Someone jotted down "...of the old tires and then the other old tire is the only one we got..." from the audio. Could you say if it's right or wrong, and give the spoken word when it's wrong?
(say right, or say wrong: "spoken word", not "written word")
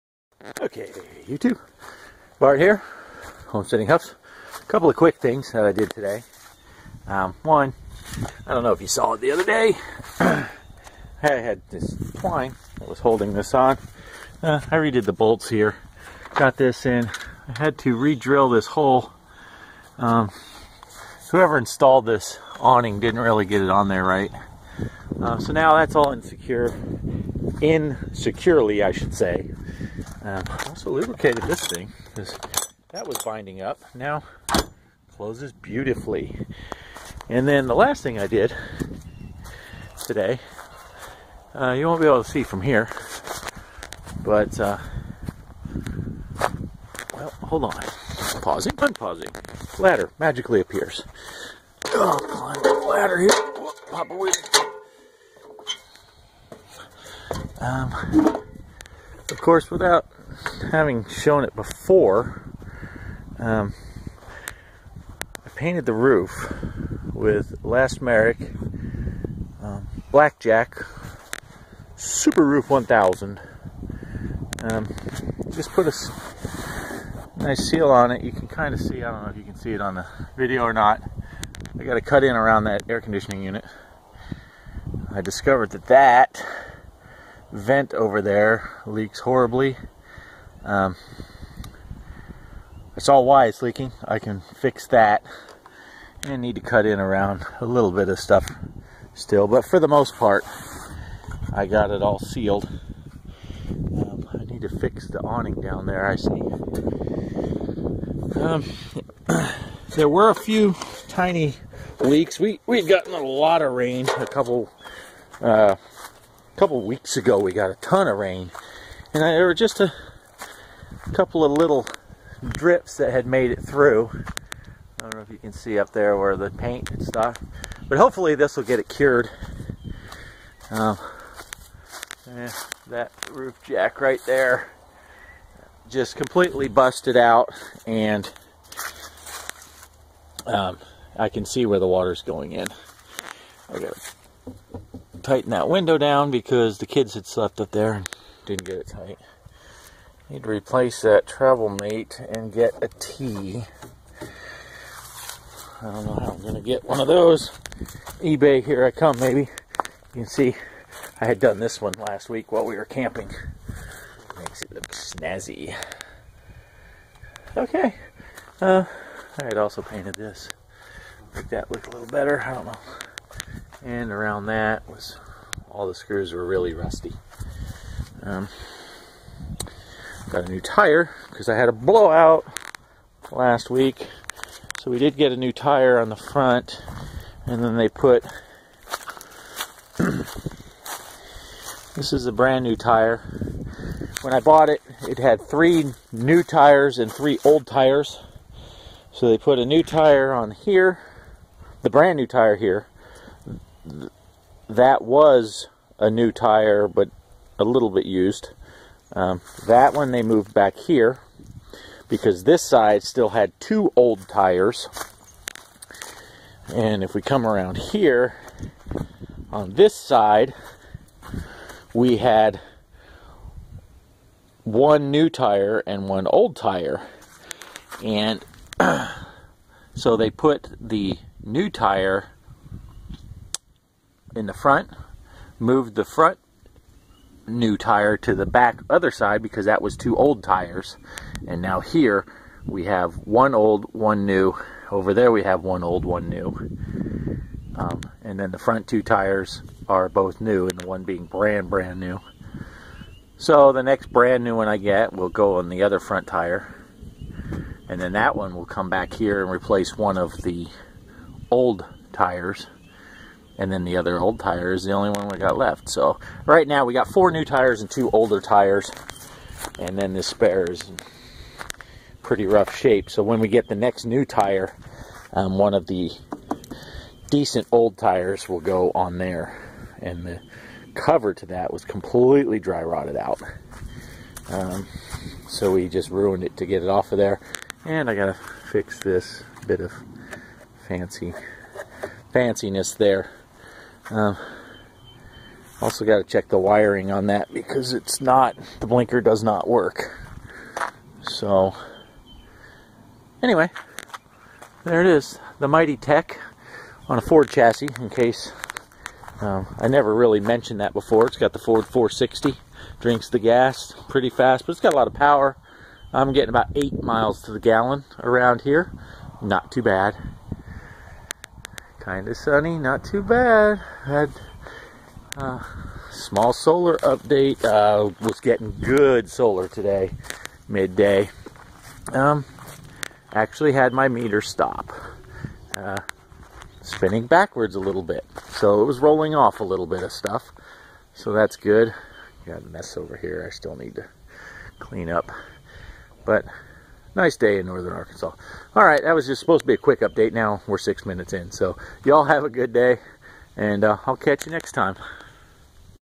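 right.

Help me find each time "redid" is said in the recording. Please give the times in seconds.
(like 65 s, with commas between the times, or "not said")
14 s.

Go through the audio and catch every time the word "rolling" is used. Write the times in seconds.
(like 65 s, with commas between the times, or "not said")
338 s.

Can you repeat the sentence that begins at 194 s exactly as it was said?
When I bought it, it had three new tires and three old tires.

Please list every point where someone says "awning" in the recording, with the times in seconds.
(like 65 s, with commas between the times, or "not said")
22 s, 105 s.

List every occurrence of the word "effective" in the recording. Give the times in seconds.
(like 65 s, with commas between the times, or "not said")
not said.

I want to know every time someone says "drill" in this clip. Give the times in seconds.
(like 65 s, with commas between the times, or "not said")
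17 s.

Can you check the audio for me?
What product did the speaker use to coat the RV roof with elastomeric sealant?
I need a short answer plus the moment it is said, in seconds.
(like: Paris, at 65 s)
Blackjack Super Roof 1000, at 70 s.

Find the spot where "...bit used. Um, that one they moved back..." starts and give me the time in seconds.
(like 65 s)
207 s.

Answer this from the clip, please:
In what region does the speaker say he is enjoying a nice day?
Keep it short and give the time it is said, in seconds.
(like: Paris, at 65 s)
northern Arkansas, at 347 s.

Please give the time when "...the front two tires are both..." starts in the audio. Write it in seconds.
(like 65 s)
248 s.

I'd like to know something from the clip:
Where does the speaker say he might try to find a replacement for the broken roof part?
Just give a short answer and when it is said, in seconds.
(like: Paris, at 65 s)
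eBay, at 158 s.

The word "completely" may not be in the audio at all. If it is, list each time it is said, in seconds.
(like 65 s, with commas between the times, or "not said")
136 s, 281 s.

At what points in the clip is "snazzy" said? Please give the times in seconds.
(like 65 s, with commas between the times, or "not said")
164 s.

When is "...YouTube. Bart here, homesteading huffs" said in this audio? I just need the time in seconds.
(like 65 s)
1 s.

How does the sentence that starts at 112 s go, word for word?
We, we'd gotten a lot of rain, a couple uh, a couple weeks ago we got a ton of rain.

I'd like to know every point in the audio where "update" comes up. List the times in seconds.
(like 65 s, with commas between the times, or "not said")
326 s, 350 s.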